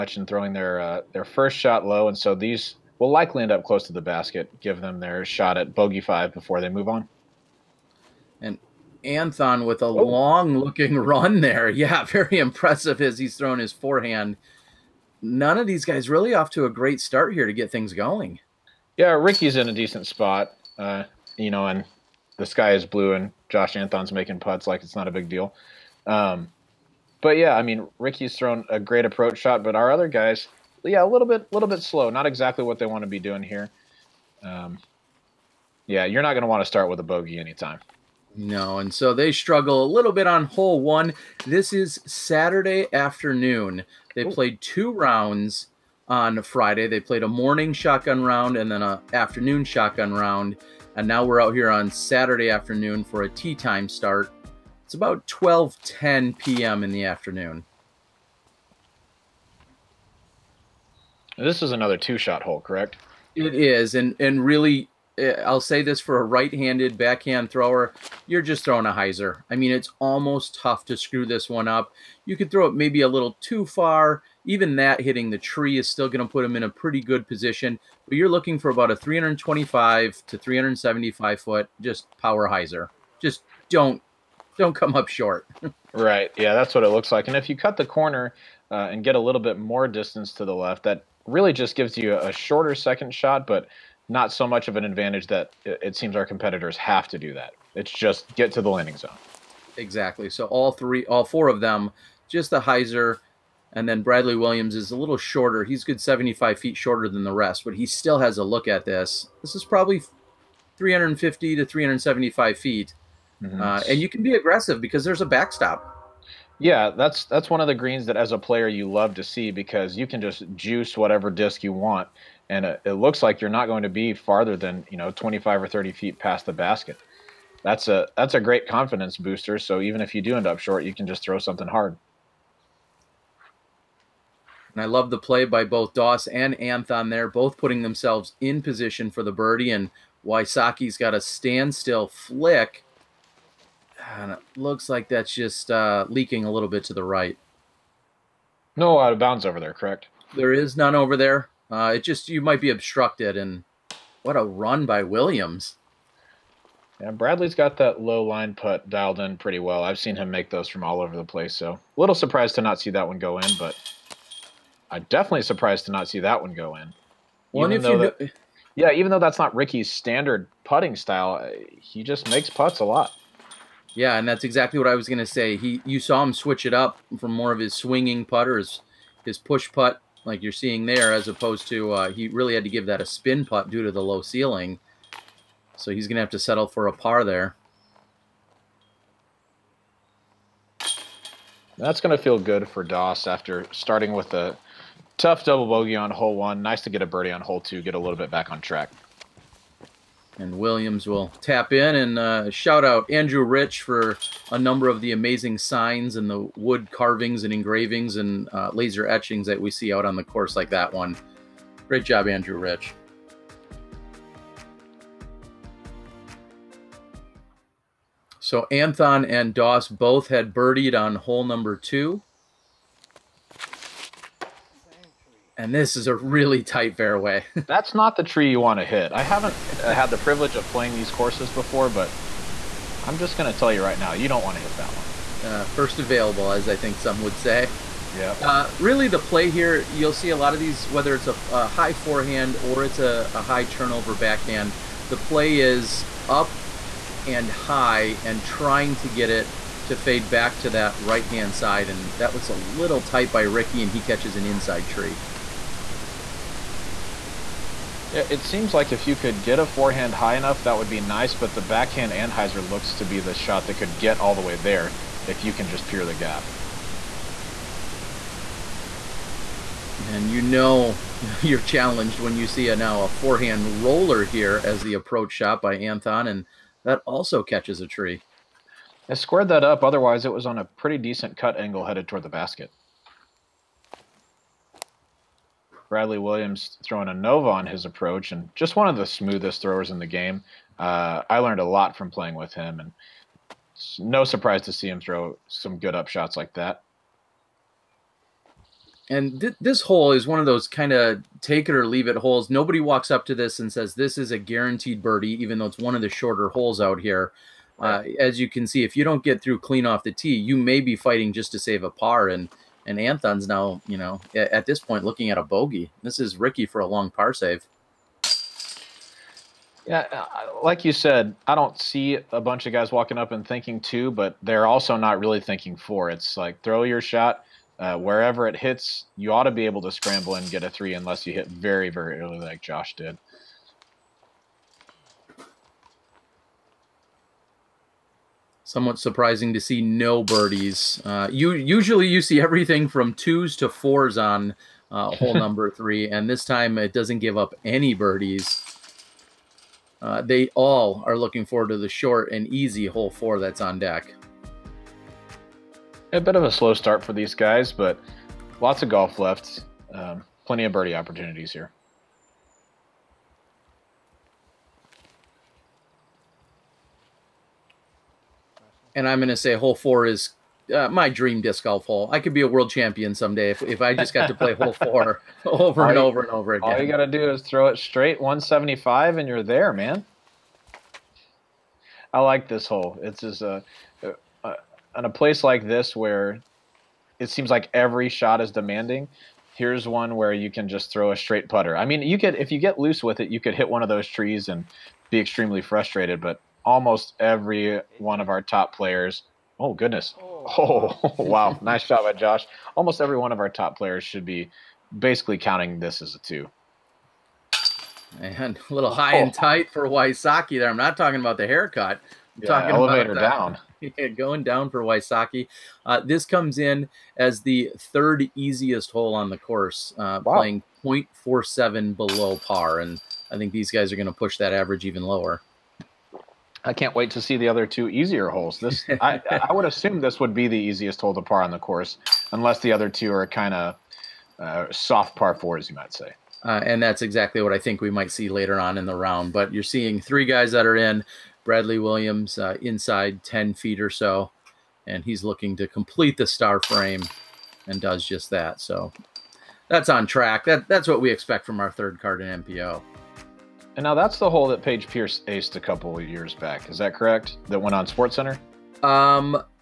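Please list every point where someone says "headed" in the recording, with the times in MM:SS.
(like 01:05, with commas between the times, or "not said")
04:41.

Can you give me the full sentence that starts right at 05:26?
It's like throw your shot uh, wherever it hits.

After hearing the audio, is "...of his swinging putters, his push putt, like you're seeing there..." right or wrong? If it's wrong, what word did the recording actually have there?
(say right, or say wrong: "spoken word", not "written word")
right.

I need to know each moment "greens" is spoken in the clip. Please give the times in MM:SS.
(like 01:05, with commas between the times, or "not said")
01:57.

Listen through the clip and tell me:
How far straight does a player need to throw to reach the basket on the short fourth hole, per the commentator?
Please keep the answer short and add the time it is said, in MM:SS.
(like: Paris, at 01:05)
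175, at 06:18.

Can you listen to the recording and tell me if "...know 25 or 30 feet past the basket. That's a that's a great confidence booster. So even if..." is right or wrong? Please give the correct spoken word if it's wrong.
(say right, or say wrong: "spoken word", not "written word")
right.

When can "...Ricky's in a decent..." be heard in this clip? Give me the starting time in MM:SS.
00:19.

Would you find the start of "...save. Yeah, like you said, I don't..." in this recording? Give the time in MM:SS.
05:17.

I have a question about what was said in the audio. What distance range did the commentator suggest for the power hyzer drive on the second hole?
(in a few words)
325 to 375 feet.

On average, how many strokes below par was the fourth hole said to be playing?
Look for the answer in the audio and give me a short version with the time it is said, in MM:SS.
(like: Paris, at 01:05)
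0.47, at 07:00.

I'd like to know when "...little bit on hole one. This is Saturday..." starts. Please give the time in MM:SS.
00:39.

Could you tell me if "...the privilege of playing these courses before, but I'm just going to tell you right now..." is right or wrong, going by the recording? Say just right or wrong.
right.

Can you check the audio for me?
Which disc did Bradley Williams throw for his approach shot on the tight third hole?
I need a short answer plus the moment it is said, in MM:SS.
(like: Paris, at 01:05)
Nova, at 04:47.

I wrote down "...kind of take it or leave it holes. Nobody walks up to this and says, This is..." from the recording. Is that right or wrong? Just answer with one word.
right.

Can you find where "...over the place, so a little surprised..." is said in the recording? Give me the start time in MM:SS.
02:41.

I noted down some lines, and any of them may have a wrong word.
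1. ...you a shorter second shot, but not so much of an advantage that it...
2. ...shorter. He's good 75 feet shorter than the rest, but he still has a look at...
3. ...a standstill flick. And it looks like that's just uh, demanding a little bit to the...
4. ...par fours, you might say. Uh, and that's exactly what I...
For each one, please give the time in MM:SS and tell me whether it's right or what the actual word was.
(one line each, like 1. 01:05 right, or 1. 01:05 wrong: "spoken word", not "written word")
1. 01:31 right
2. 01:45 right
3. 02:21 wrong: "leaking", not "demanding"
4. 07:15 right.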